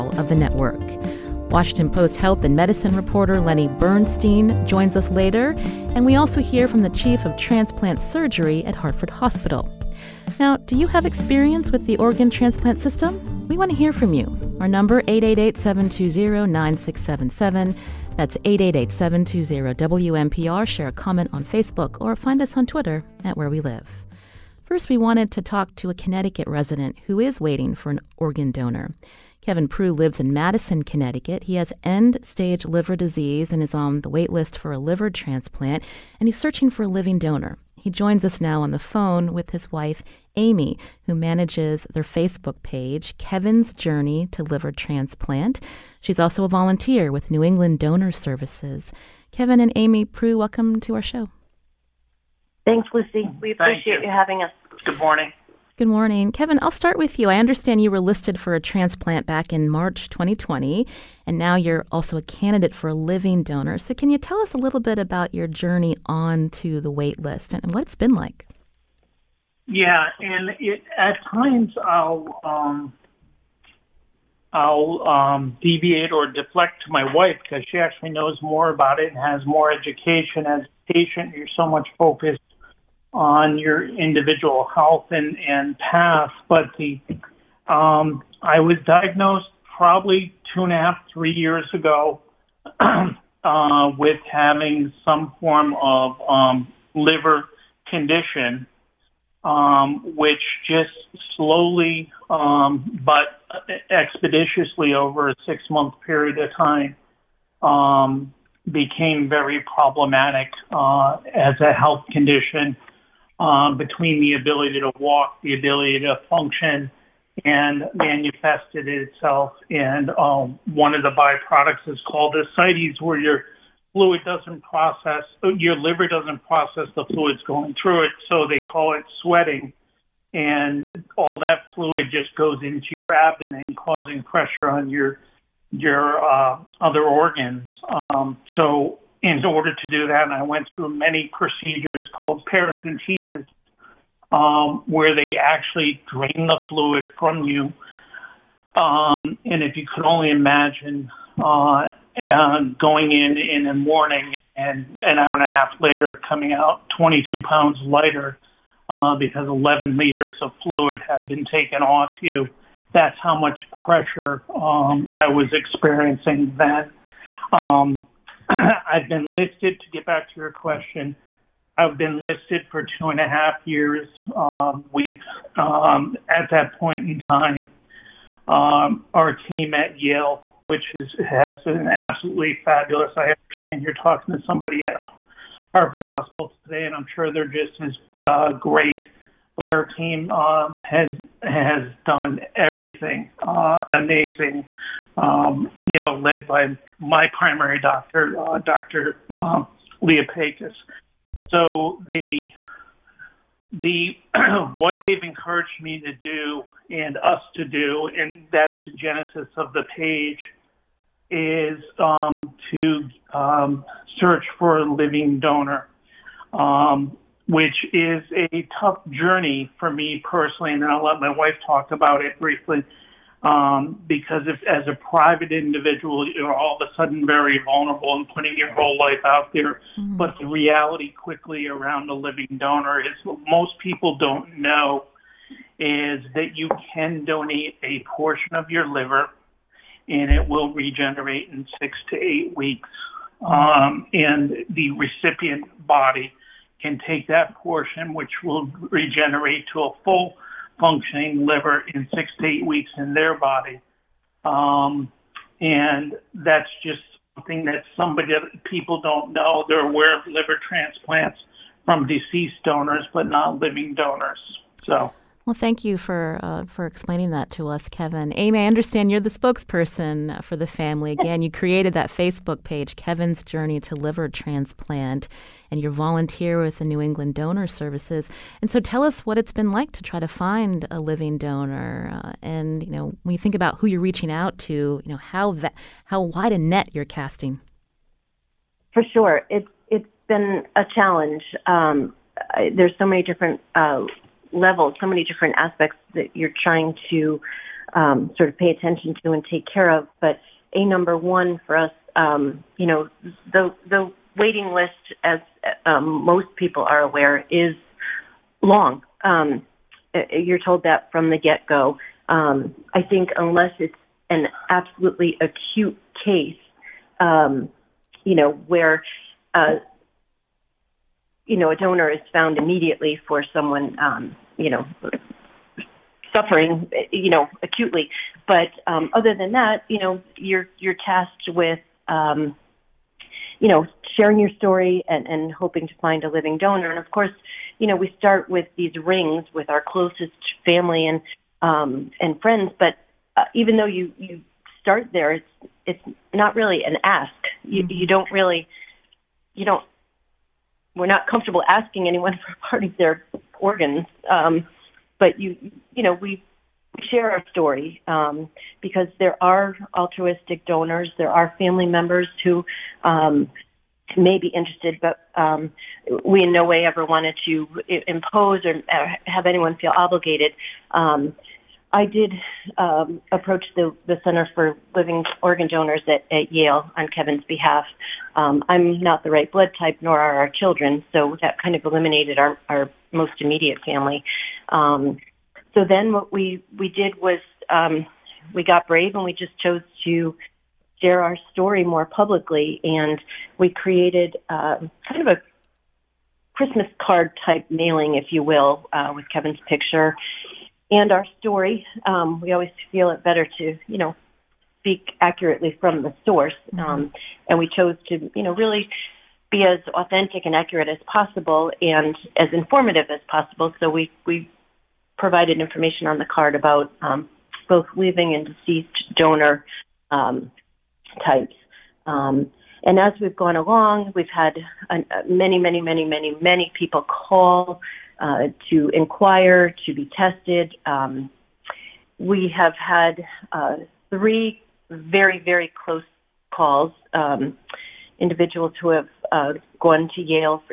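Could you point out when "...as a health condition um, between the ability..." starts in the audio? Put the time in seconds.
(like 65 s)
111 s.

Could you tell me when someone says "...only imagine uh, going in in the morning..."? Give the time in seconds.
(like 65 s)
150 s.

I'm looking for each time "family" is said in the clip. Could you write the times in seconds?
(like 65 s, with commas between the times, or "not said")
270 s, 340 s, 361 s, 383 s.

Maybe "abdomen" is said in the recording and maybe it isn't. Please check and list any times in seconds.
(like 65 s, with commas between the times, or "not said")
133 s.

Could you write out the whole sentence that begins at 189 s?
But our team um, has has done everything uh, amazing.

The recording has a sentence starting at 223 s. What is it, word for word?
Um, because if, as a private individual, you're all of a sudden very vulnerable and putting your whole life out there.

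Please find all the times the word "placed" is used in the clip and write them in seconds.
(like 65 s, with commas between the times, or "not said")
not said.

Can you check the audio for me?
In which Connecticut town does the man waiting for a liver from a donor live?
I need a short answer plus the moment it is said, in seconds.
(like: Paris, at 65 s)
Madison, at 30 s.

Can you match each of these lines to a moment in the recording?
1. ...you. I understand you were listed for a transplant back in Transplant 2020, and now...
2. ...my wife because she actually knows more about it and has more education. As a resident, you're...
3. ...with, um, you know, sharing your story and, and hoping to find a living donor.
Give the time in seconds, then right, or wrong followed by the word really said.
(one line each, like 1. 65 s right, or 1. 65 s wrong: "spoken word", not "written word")
1. 57 s wrong: "March", not "Transplant"
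2. 76 s wrong: "patient", not "resident"
3. 331 s right.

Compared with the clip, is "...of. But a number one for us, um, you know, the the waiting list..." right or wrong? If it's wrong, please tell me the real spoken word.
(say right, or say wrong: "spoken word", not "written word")
right.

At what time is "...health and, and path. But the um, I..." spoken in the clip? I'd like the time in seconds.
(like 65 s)
84 s.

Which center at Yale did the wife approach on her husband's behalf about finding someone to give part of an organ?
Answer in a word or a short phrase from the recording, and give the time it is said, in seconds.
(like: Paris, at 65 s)
Center for Living Organ Donors, at 374 s.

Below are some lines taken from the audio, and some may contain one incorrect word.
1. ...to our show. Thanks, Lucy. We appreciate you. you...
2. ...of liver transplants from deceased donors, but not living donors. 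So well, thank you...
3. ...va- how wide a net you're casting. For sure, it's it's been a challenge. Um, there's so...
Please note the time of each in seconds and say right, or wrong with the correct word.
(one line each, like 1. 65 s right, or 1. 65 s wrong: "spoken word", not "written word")
1. 50 s right
2. 260 s right
3. 285 s right.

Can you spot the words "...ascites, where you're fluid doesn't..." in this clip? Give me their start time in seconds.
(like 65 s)
122 s.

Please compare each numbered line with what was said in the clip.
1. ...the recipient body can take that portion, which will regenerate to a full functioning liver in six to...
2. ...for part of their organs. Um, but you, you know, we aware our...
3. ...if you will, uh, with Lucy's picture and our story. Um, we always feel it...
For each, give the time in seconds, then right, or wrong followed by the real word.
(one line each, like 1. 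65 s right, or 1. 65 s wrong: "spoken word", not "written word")
1. 244 s right
2. 352 s wrong: "share", not "aware"
3. 398 s wrong: "Kevin", not "Lucy".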